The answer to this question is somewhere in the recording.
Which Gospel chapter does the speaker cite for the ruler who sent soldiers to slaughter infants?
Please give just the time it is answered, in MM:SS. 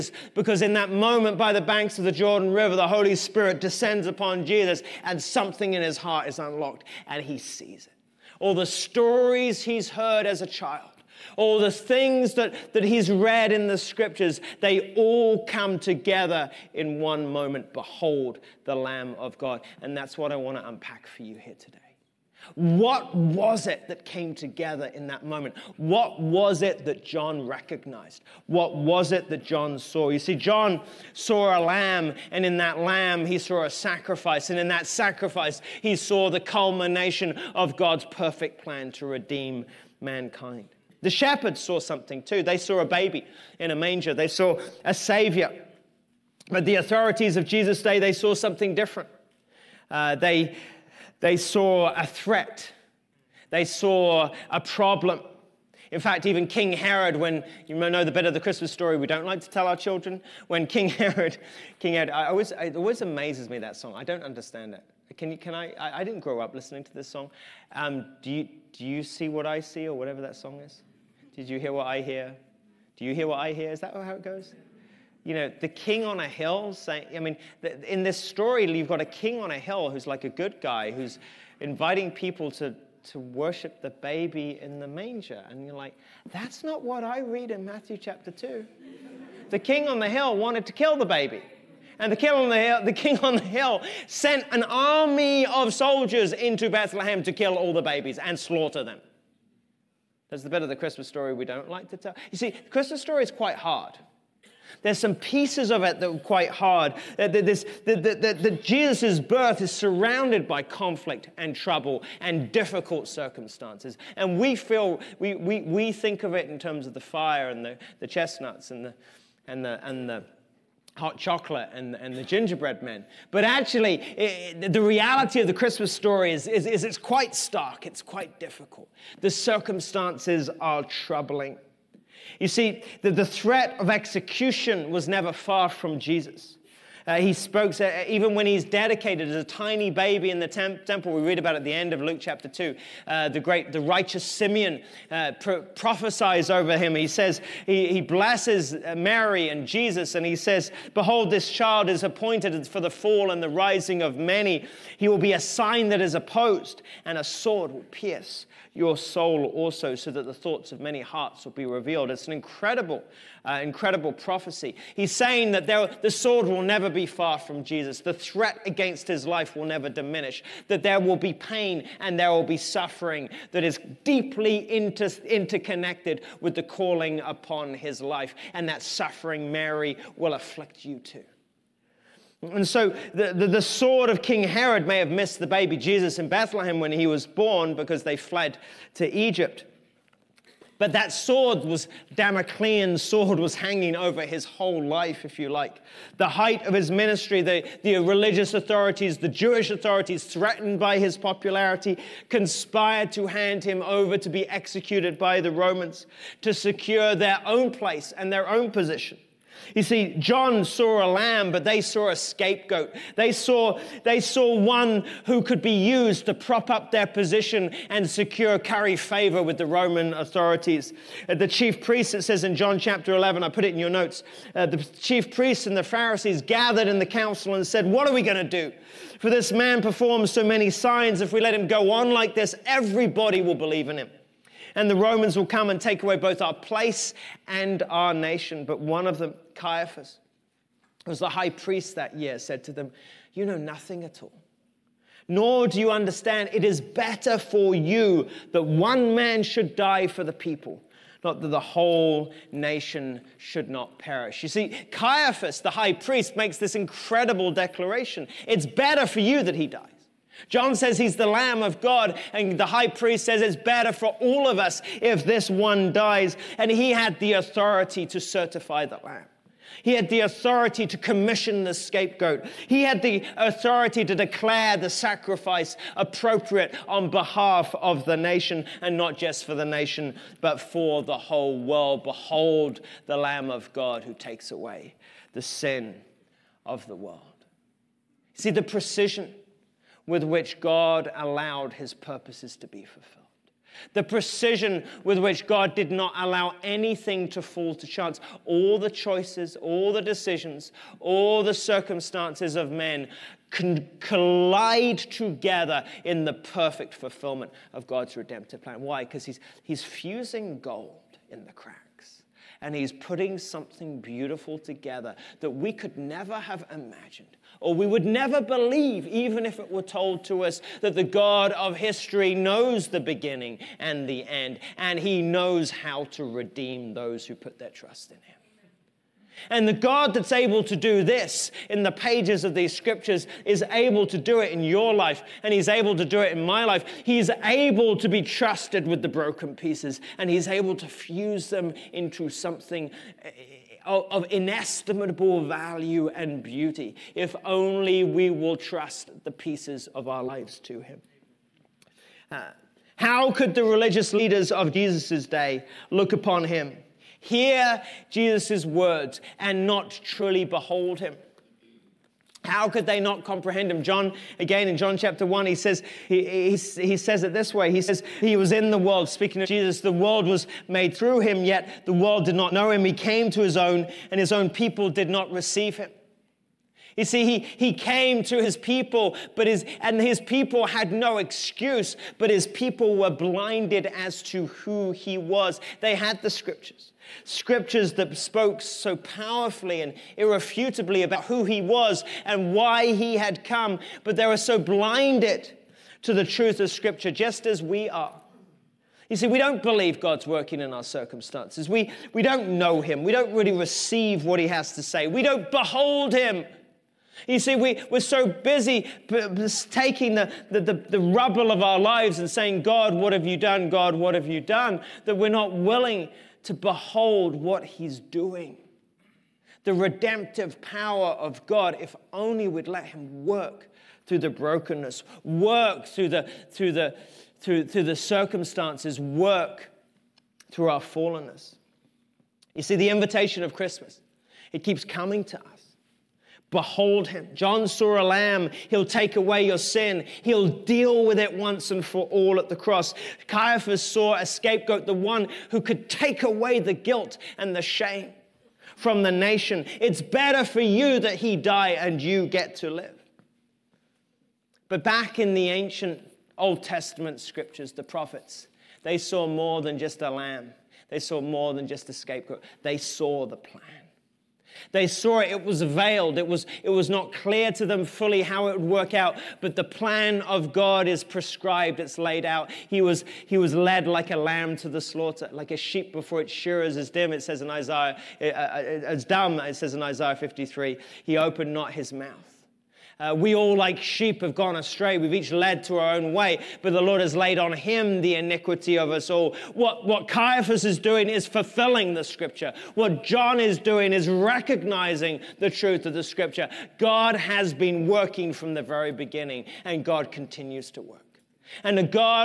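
01:27.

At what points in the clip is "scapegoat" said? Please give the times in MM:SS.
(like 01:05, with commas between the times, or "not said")
03:32, 04:31, 07:24, 07:41.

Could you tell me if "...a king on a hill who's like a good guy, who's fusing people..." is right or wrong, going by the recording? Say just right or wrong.
wrong.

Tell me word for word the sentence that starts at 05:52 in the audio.
Uh, how could the religious leaders of Jesus' day look upon Him?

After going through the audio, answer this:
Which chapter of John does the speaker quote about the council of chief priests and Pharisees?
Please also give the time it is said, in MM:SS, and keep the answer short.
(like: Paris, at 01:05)
John chapter 11, at 03:42.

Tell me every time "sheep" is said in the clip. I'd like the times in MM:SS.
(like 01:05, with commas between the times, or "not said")
07:55, 08:03.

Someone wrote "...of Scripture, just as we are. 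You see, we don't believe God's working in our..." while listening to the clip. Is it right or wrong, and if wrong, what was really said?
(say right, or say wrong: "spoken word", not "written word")
right.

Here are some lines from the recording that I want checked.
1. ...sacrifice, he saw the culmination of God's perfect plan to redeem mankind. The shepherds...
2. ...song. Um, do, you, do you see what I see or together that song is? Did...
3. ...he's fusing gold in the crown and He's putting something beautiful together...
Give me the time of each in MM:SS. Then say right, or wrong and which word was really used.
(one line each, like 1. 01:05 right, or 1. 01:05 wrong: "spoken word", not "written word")
1. 00:34 right
2. 01:07 wrong: "whatever", not "together"
3. 05:09 right.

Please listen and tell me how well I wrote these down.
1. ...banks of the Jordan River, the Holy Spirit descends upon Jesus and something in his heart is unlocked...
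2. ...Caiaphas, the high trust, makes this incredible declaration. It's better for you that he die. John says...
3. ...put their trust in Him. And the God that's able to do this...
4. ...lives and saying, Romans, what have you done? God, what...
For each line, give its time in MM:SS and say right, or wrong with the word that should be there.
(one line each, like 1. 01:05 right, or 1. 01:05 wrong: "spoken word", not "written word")
1. 00:01 right
2. 04:14 wrong: "priest", not "trust"
3. 05:27 right
4. 06:51 wrong: "God", not "Romans".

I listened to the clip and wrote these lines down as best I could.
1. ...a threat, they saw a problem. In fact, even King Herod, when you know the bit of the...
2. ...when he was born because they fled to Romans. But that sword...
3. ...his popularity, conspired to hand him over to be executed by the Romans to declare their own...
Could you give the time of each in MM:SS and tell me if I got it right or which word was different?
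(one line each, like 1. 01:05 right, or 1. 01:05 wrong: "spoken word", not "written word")
1. 00:51 right
2. 03:06 wrong: "Egypt", not "Romans"
3. 03:20 wrong: "secure", not "declare".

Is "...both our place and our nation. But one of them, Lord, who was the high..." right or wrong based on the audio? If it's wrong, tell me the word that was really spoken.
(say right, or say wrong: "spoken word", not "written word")
wrong: "Caiaphas", not "Lord".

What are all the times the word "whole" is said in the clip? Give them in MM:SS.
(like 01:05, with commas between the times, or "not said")
03:14, 04:11, 04:41.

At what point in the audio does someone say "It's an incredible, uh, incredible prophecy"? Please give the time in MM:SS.
02:42.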